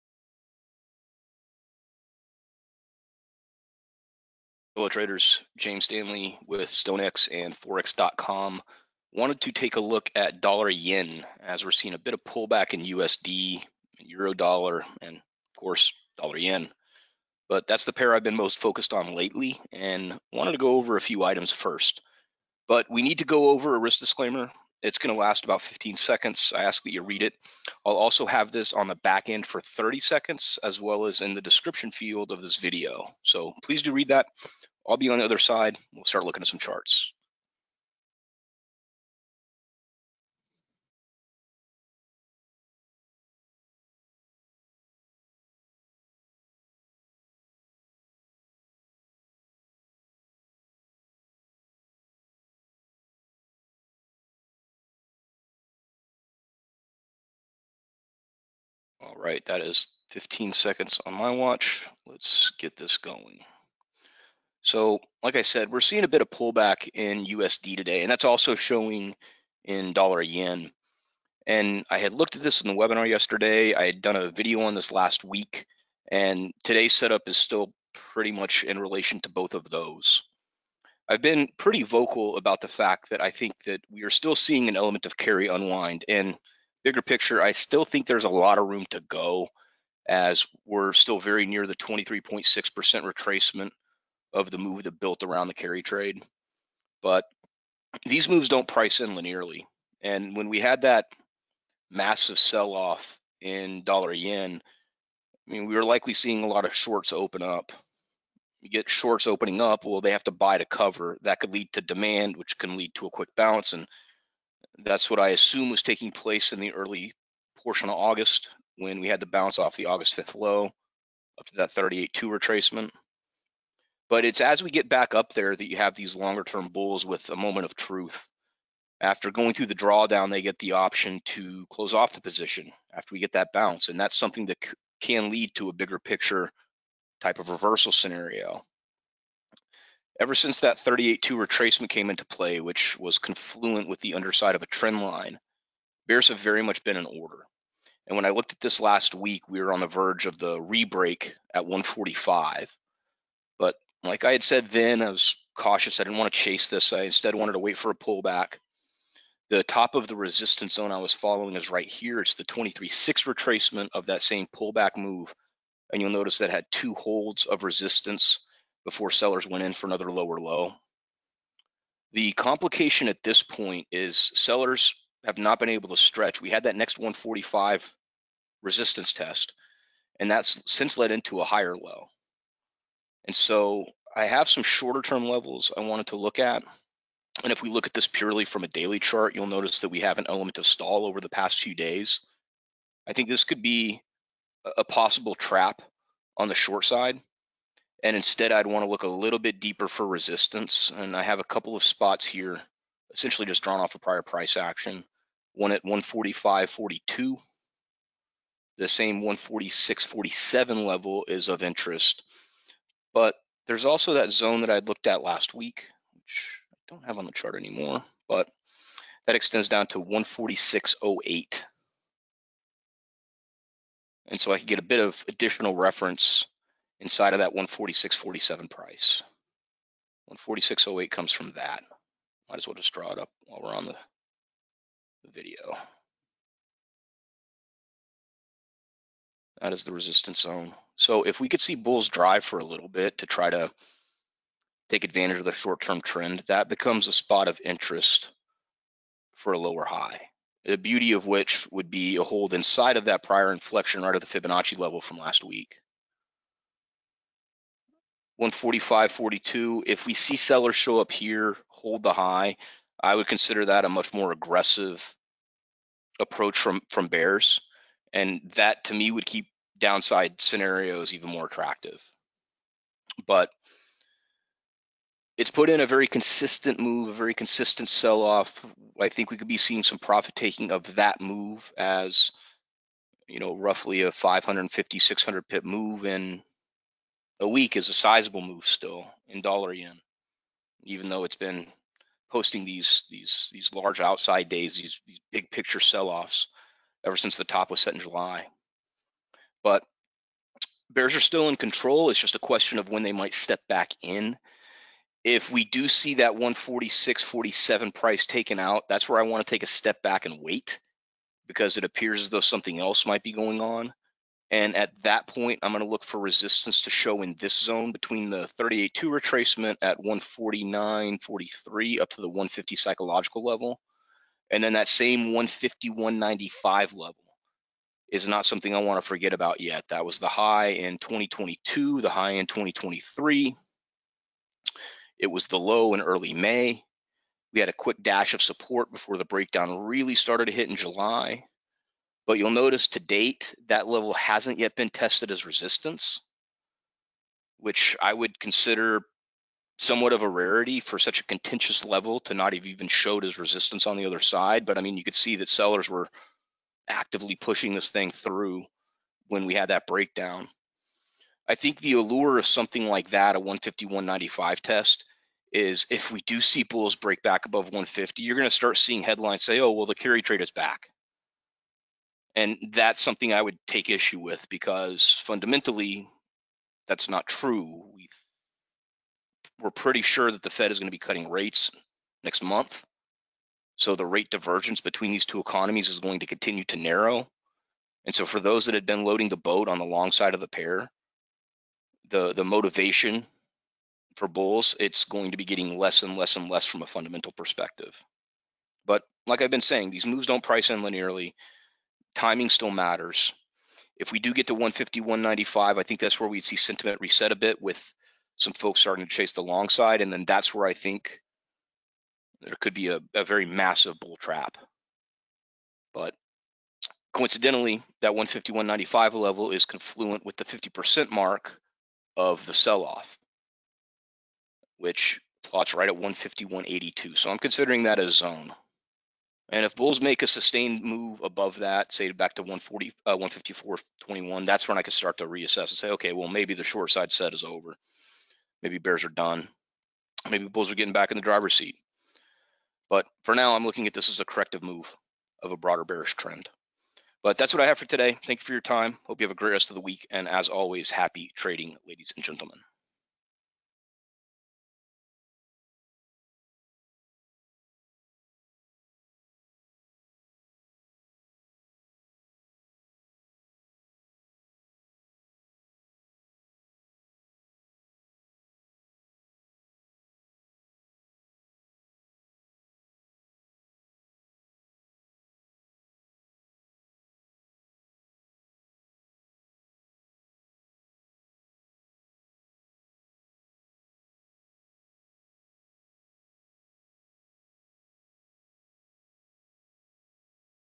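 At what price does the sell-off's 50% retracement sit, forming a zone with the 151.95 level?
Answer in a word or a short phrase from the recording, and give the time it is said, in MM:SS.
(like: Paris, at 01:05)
151.82, at 07:05.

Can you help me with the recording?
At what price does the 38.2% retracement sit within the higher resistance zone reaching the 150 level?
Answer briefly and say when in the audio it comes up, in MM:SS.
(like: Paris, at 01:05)
149.43, at 05:19.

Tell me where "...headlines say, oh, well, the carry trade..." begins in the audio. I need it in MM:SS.
06:09.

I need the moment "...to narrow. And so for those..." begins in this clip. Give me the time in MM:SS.
06:26.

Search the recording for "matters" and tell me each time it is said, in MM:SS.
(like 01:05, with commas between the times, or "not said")
06:42.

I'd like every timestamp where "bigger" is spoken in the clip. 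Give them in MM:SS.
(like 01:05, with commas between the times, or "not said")
01:26, 02:15.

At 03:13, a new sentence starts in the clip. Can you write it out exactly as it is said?
I think this could be a possible trap on the short side.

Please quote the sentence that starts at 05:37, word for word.
We had a quick dash of support before the breakdown really started to hit in July.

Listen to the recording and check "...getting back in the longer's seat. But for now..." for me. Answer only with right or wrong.
wrong.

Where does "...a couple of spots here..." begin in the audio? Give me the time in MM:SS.
03:21.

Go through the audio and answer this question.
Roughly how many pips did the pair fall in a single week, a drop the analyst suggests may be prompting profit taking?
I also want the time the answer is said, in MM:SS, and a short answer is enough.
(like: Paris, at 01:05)
550 to 600 pips, at 04:44.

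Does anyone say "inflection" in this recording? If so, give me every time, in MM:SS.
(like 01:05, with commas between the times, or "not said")
04:13.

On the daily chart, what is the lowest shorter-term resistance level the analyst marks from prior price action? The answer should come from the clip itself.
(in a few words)
145.42.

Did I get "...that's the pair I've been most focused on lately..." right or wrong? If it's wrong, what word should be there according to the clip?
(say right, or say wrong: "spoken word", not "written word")
right.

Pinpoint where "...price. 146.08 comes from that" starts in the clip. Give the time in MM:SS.
03:48.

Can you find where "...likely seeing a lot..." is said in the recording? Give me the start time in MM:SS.
01:45.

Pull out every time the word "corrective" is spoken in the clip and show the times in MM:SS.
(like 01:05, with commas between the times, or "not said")
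07:24.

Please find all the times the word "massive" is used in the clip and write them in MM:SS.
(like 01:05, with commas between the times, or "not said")
01:41, 06:53.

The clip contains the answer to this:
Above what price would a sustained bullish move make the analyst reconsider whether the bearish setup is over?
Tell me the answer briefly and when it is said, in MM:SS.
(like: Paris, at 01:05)
154.21, at 07:13.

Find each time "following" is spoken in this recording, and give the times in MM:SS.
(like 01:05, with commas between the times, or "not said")
02:41.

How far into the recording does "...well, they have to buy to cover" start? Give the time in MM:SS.
01:49.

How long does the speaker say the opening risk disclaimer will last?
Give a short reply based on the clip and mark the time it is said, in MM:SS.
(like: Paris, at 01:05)
15 seconds, at 00:25.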